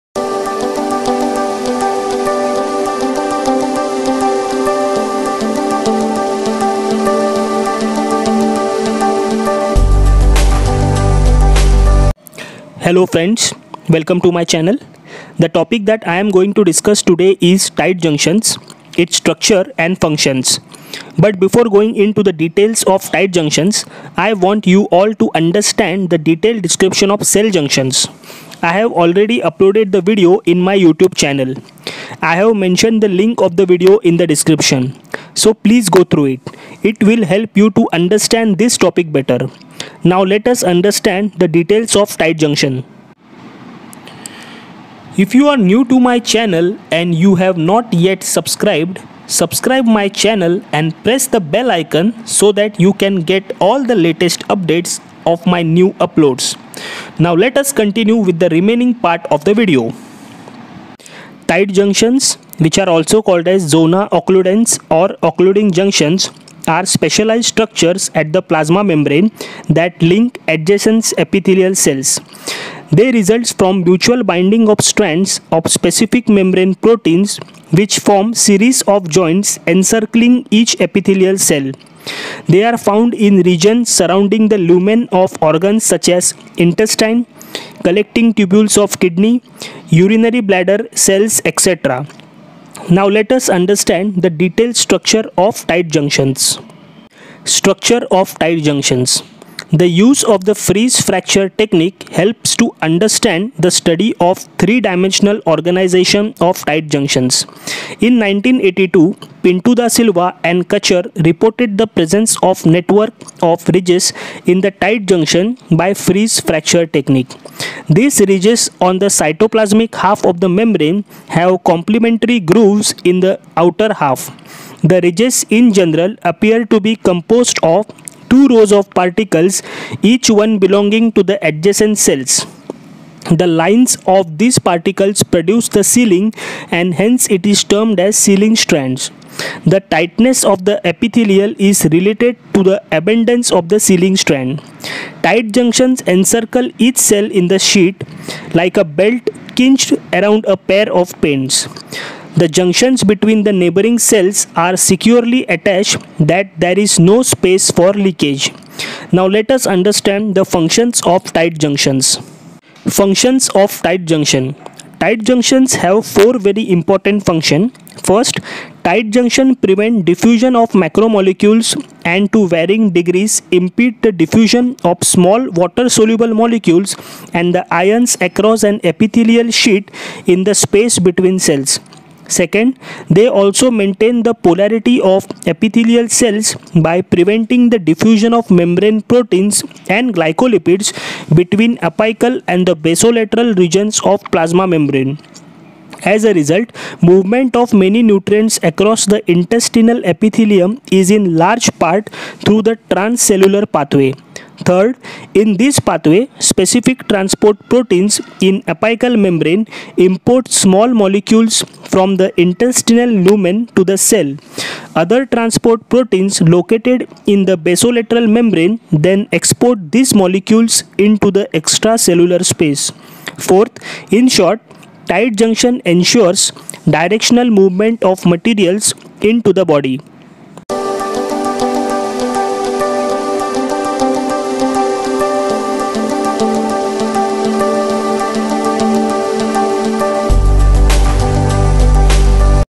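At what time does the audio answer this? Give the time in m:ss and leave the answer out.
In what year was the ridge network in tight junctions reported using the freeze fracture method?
1:48.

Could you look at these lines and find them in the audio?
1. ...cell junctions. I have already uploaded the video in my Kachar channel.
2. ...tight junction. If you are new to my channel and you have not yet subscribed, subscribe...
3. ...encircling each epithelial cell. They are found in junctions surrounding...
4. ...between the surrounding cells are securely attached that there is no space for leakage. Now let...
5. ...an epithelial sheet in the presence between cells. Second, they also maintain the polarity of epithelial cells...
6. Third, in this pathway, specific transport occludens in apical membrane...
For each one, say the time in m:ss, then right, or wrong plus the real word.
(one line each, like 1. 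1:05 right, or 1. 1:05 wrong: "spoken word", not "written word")
1. 0:27 wrong: "YouTube", not "Kachar"
2. 0:42 right
3. 1:19 wrong: "regions", not "junctions"
4. 2:33 wrong: "neighboring", not "surrounding"
5. 2:58 wrong: "space", not "presence"
6. 3:24 wrong: "proteins", not "occludens".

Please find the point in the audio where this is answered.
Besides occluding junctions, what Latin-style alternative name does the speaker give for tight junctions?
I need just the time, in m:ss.
1:03.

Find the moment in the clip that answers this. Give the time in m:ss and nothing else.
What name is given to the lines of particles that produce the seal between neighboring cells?
2:18.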